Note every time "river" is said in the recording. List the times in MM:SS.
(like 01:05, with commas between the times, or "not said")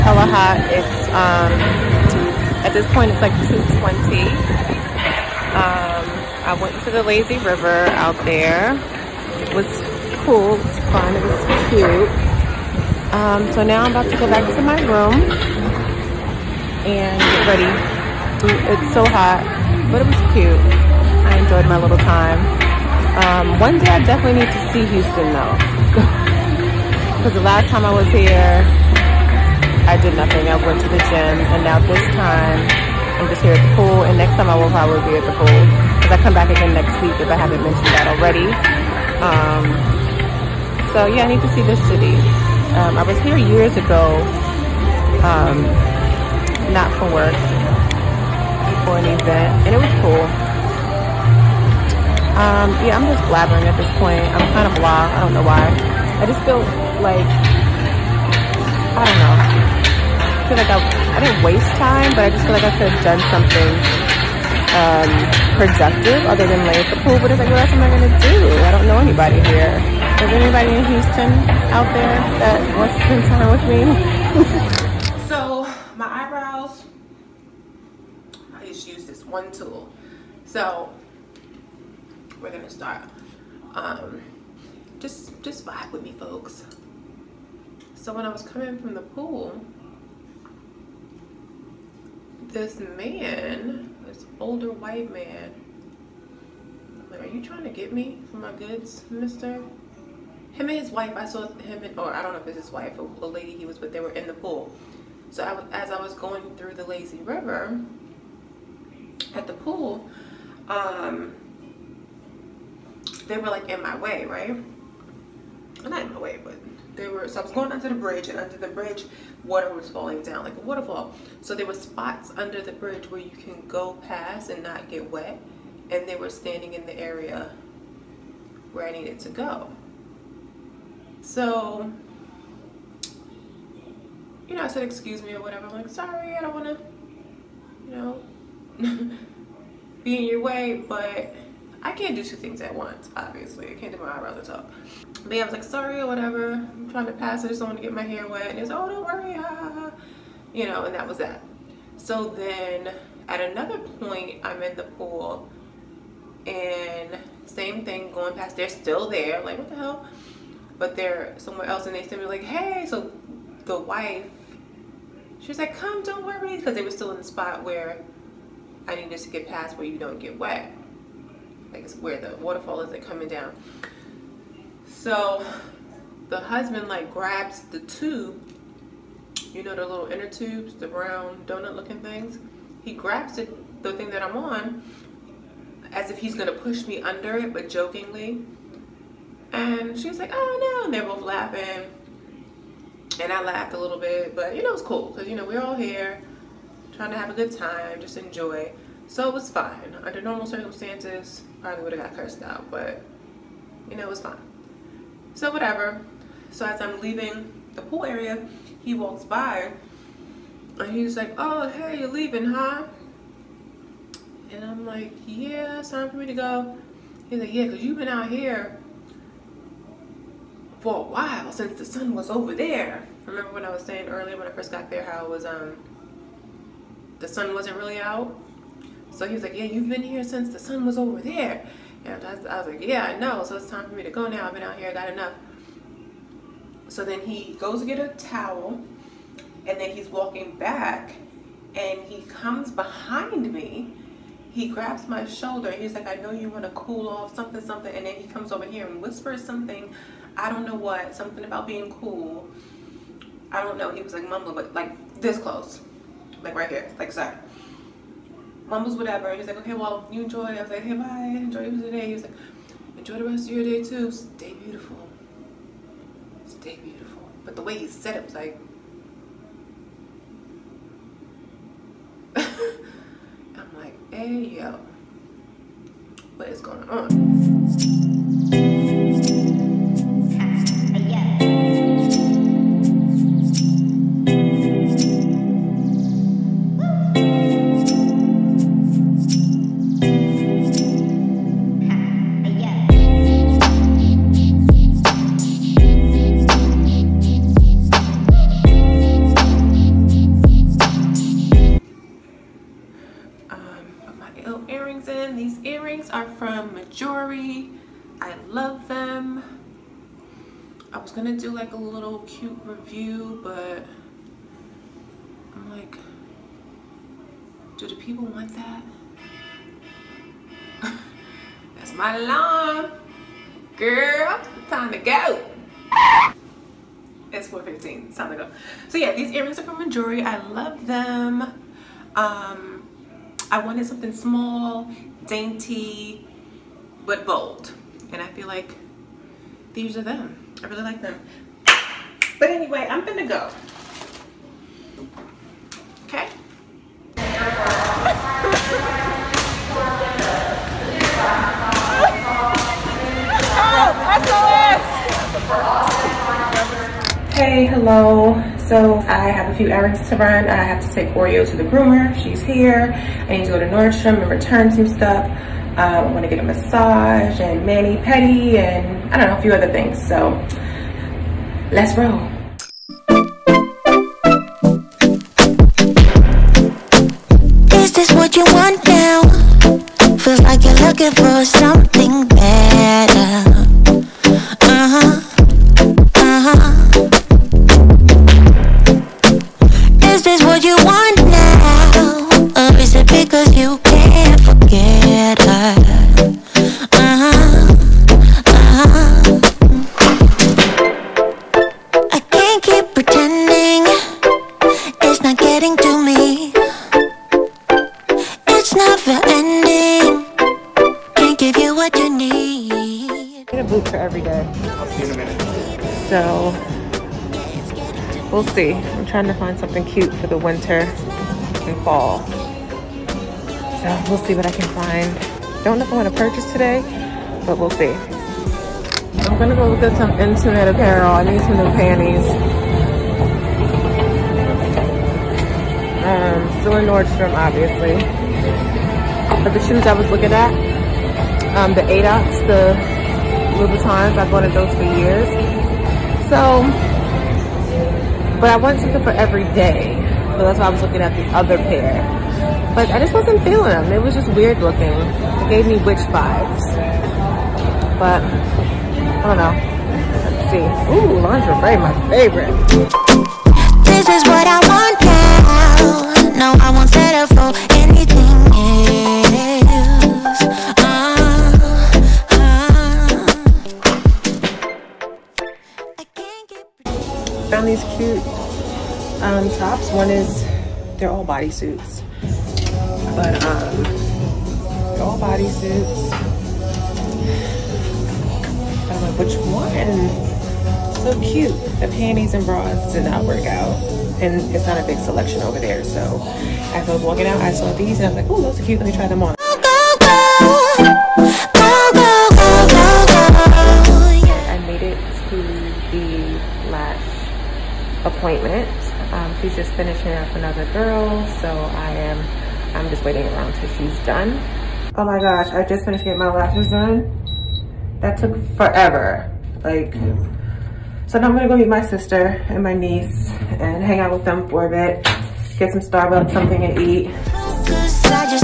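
00:07, 01:47.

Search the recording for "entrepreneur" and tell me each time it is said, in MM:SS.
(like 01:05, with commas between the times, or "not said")
not said.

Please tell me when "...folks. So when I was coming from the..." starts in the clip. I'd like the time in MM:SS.
01:26.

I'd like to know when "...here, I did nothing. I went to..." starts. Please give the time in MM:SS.
00:28.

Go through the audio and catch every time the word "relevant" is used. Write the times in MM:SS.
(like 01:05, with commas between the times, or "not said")
not said.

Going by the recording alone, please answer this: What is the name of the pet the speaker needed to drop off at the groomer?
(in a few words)
Oreo.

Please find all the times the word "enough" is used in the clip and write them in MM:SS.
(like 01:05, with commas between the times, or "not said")
03:55.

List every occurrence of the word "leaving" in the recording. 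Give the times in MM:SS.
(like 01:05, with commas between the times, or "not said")
03:27, 03:32.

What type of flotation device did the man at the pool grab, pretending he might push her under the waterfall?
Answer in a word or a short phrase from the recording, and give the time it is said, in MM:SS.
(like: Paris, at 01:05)
inner tubes, at 03:00.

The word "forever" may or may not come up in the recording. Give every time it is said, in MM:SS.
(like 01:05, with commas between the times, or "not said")
08:38.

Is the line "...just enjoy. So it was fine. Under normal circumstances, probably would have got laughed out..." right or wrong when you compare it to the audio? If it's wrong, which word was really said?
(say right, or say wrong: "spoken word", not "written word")
wrong: "cursed", not "laughed".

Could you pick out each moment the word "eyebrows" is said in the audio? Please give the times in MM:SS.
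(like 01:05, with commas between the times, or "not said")
01:16, 02:24.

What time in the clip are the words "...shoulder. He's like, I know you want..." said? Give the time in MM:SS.
04:05.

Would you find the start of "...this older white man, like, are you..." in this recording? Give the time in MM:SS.
01:34.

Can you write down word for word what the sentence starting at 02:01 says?
So there were spots under the bridge where you can go past and not get wet.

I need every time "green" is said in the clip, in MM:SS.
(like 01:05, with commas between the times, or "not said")
not said.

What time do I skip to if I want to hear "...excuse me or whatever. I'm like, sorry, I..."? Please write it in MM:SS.
02:14.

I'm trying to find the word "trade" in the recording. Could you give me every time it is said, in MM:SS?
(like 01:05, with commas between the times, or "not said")
not said.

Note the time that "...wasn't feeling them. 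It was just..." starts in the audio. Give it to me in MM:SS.
07:33.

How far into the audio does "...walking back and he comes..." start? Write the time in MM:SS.
04:00.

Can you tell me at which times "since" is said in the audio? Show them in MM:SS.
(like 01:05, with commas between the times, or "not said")
03:41, 03:50.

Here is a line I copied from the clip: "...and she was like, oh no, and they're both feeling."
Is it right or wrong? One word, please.
wrong.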